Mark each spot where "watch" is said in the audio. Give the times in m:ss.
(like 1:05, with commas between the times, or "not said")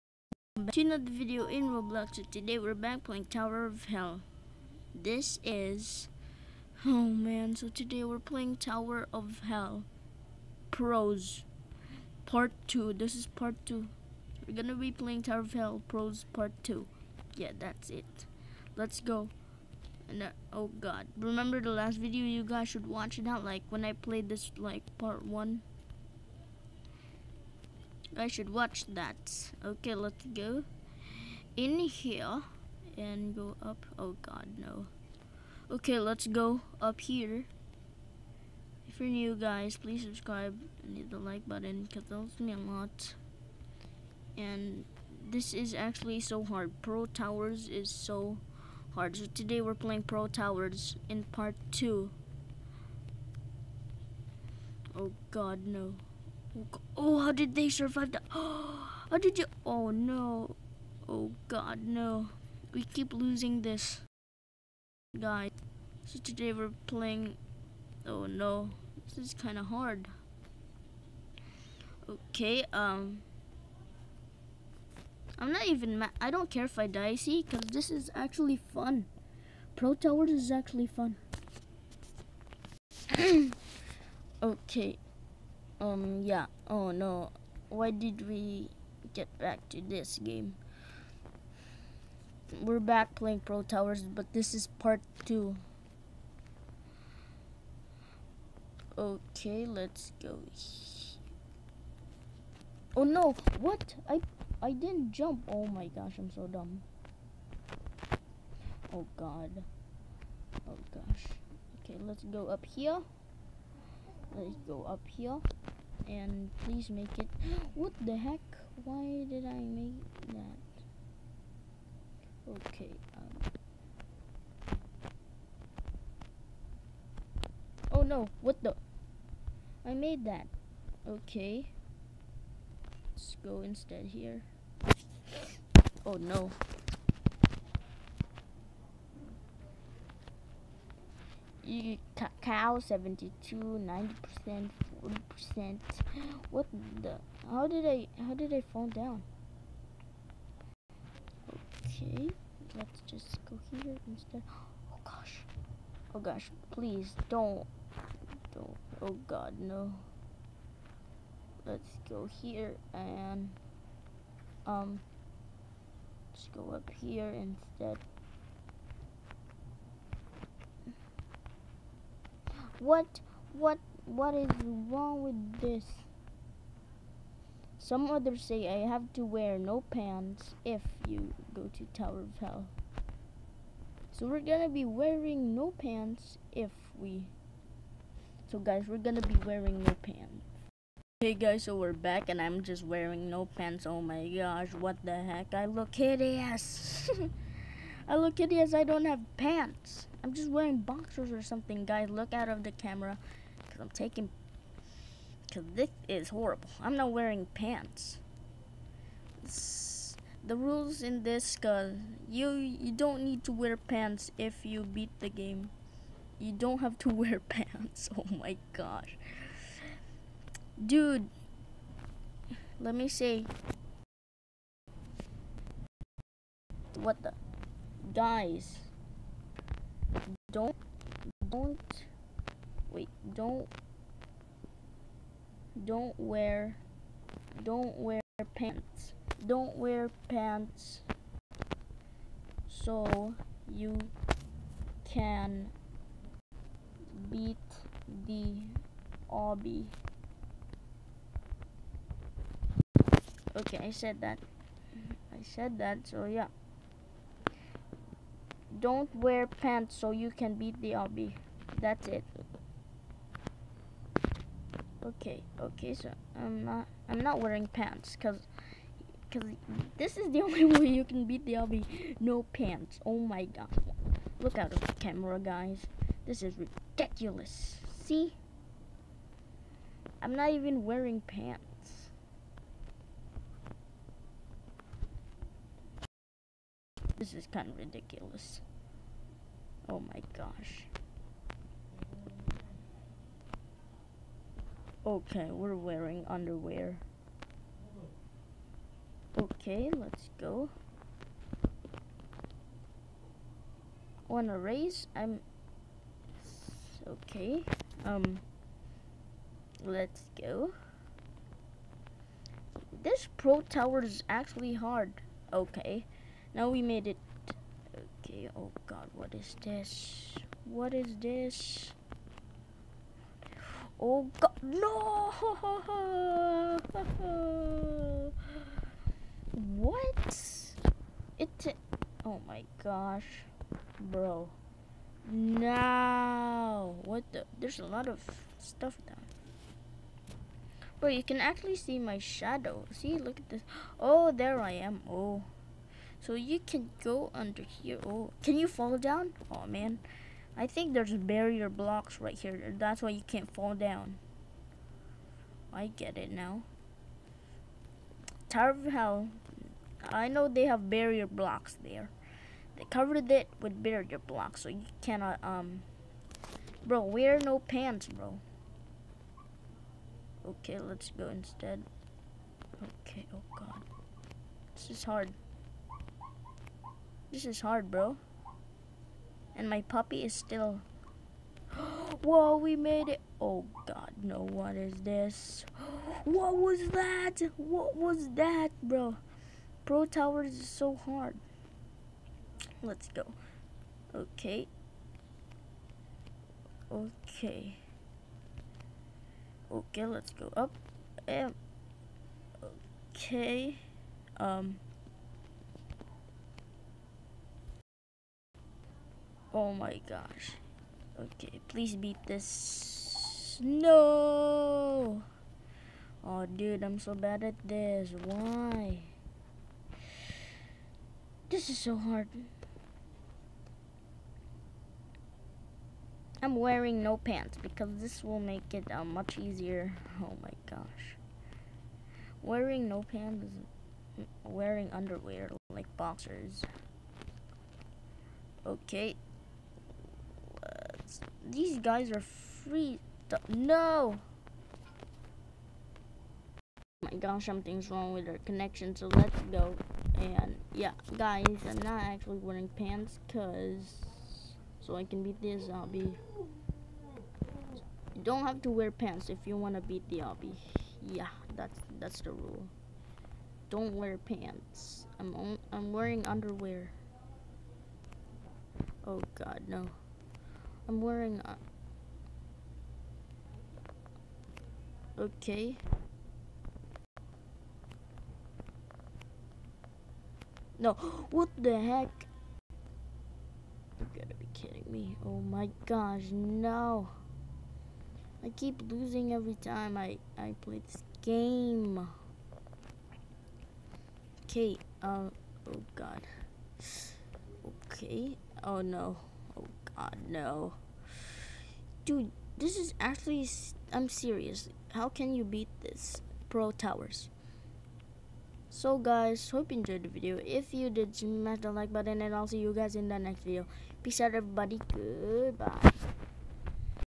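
0:22, 0:28.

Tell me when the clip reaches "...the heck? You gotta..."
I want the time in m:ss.
8:01.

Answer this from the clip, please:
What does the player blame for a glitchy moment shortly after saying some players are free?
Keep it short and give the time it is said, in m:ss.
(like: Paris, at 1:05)
Connection, at 7:27.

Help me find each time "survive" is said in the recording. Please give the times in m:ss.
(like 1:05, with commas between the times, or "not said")
0:57.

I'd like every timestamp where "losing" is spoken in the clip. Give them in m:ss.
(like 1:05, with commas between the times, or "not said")
1:03, 8:08.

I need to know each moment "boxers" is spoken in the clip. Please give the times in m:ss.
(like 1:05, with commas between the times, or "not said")
3:20, 7:15.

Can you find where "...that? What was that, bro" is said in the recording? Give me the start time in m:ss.
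6:26.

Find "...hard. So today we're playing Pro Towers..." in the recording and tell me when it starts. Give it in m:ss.
0:48.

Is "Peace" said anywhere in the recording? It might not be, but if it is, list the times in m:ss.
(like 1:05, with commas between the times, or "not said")
8:34.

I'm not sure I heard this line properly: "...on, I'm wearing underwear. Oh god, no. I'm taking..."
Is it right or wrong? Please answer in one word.
wrong.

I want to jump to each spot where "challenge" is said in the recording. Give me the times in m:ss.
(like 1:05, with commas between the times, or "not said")
not said.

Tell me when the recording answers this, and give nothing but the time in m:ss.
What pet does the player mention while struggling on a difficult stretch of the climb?
6:19.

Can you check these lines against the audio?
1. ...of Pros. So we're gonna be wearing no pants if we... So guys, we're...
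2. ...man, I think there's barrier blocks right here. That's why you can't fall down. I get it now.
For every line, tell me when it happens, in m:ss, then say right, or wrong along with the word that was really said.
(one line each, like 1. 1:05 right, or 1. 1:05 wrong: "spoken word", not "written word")
1. 3:02 wrong: "Hell", not "Pros"
2. 5:49 right.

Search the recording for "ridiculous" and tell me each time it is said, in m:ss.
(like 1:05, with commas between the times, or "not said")
4:36, 4:47.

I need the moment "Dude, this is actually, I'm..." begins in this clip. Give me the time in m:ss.
8:22.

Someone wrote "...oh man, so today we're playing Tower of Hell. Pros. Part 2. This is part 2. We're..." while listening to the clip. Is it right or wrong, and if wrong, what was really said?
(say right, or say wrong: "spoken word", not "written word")
right.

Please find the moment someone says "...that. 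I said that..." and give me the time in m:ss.
4:14.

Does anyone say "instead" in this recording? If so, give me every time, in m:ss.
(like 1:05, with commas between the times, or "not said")
2:13, 2:34, 2:47, 6:11.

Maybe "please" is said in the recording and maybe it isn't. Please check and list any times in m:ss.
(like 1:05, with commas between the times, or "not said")
0:39, 1:56, 2:36, 6:51.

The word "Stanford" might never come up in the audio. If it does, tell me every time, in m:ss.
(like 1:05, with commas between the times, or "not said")
not said.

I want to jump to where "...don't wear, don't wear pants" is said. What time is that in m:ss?
3:55.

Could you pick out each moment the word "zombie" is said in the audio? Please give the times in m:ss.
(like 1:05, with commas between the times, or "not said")
7:35, 7:40.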